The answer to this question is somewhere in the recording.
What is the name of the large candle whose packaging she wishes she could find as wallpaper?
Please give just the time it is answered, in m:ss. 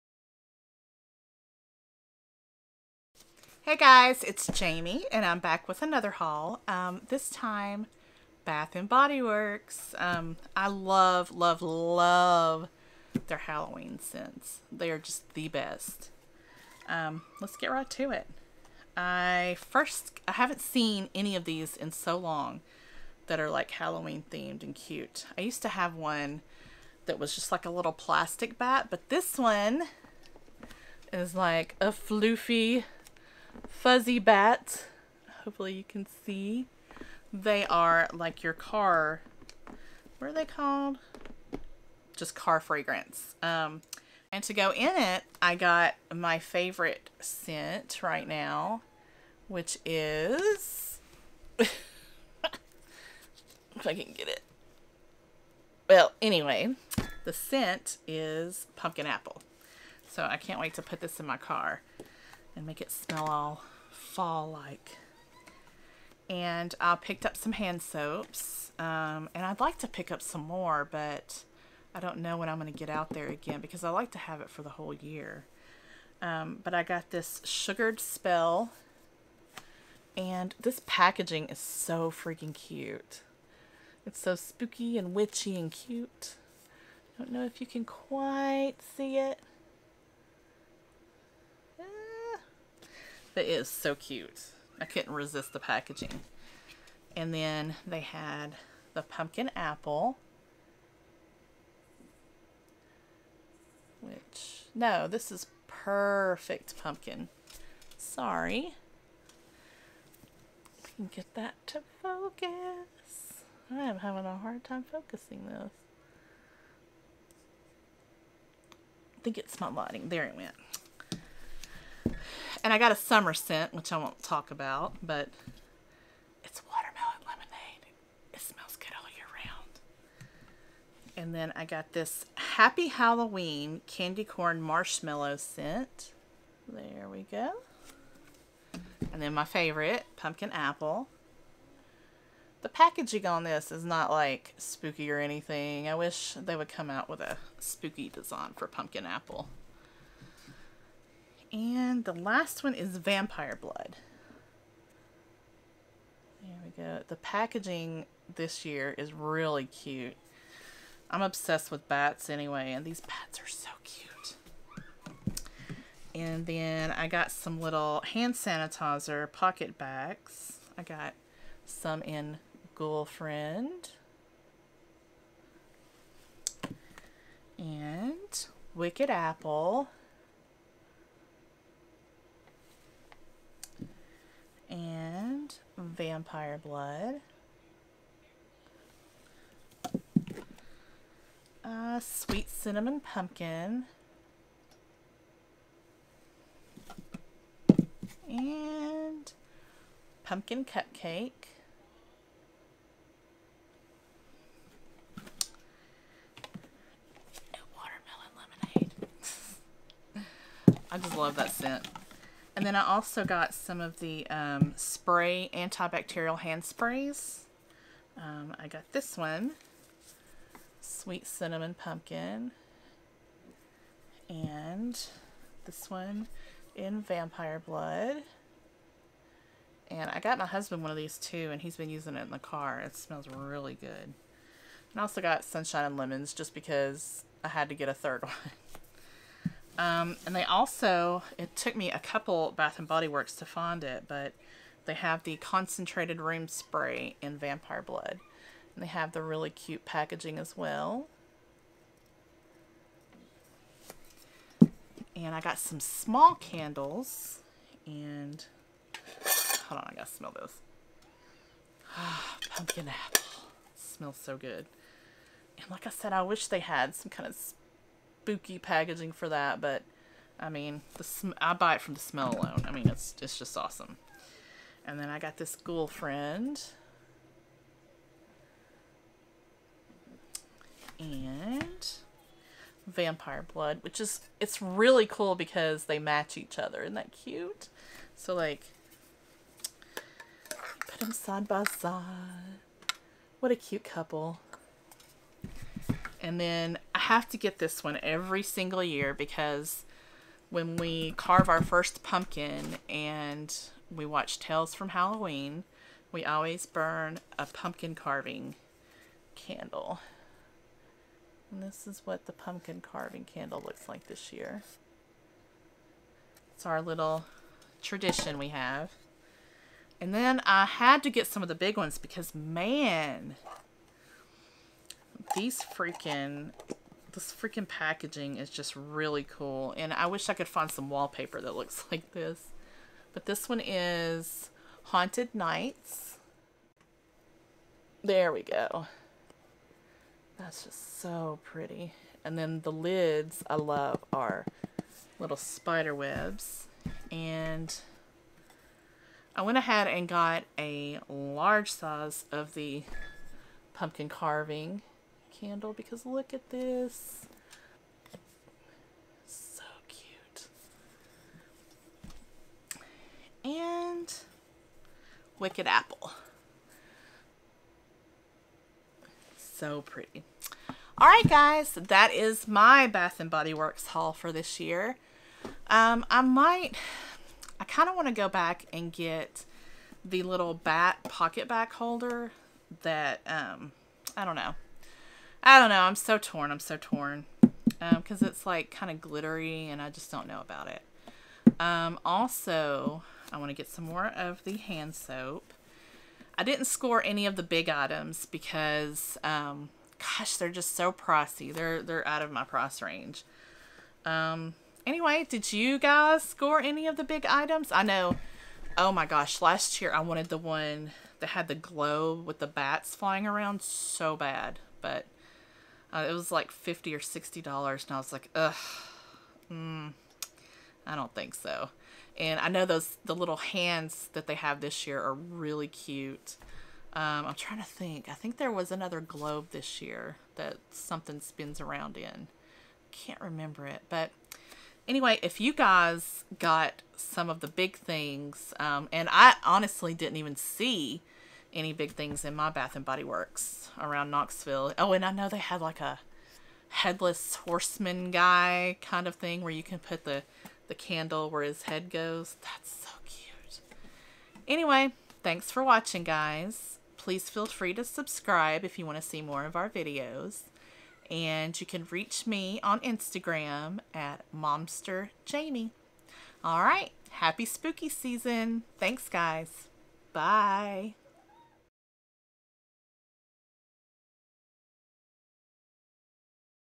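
5:34.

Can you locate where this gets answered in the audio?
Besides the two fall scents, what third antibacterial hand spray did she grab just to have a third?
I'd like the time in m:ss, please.
3:55.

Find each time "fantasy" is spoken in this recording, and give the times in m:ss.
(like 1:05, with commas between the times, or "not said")
not said.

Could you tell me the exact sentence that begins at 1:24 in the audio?
It's so spooky and witchy and cute.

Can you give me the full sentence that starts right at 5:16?
It's our little tradition we have.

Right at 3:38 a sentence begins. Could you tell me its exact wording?
Um, I got this one, sweet cinnamon pumpkin, and this one in vampire blood.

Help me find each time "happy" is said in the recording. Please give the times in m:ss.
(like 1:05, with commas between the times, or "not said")
2:12, 7:47.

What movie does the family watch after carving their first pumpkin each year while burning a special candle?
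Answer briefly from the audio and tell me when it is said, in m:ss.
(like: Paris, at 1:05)
Tales from Halloween, at 5:04.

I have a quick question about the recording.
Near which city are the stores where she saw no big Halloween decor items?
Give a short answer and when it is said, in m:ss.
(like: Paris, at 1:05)
Knoxville, at 7:24.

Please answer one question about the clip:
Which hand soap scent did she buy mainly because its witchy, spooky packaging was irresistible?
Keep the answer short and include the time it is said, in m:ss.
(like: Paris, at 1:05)
Sugared Spell, at 1:17.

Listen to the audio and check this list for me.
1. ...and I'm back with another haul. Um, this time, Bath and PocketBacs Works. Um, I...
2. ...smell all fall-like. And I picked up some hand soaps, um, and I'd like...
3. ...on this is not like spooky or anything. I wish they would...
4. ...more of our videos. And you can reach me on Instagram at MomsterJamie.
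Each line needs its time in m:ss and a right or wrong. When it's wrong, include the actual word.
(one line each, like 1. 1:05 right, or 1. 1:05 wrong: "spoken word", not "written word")
1. 0:05 wrong: "Body", not "PocketBacs"
2. 1:02 right
3. 2:23 right
4. 7:39 right.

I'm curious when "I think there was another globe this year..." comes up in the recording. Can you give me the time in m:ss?
7:08.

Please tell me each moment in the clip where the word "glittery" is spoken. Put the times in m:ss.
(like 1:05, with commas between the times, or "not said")
6:29.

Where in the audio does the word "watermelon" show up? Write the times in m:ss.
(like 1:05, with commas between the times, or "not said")
2:06, 3:27.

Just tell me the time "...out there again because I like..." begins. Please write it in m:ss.
1:12.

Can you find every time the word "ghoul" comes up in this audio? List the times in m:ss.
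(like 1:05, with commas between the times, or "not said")
2:52, 4:35.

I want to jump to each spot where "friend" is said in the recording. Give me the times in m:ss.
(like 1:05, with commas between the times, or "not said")
2:53, 4:35.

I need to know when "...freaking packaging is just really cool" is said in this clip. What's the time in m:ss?
5:27.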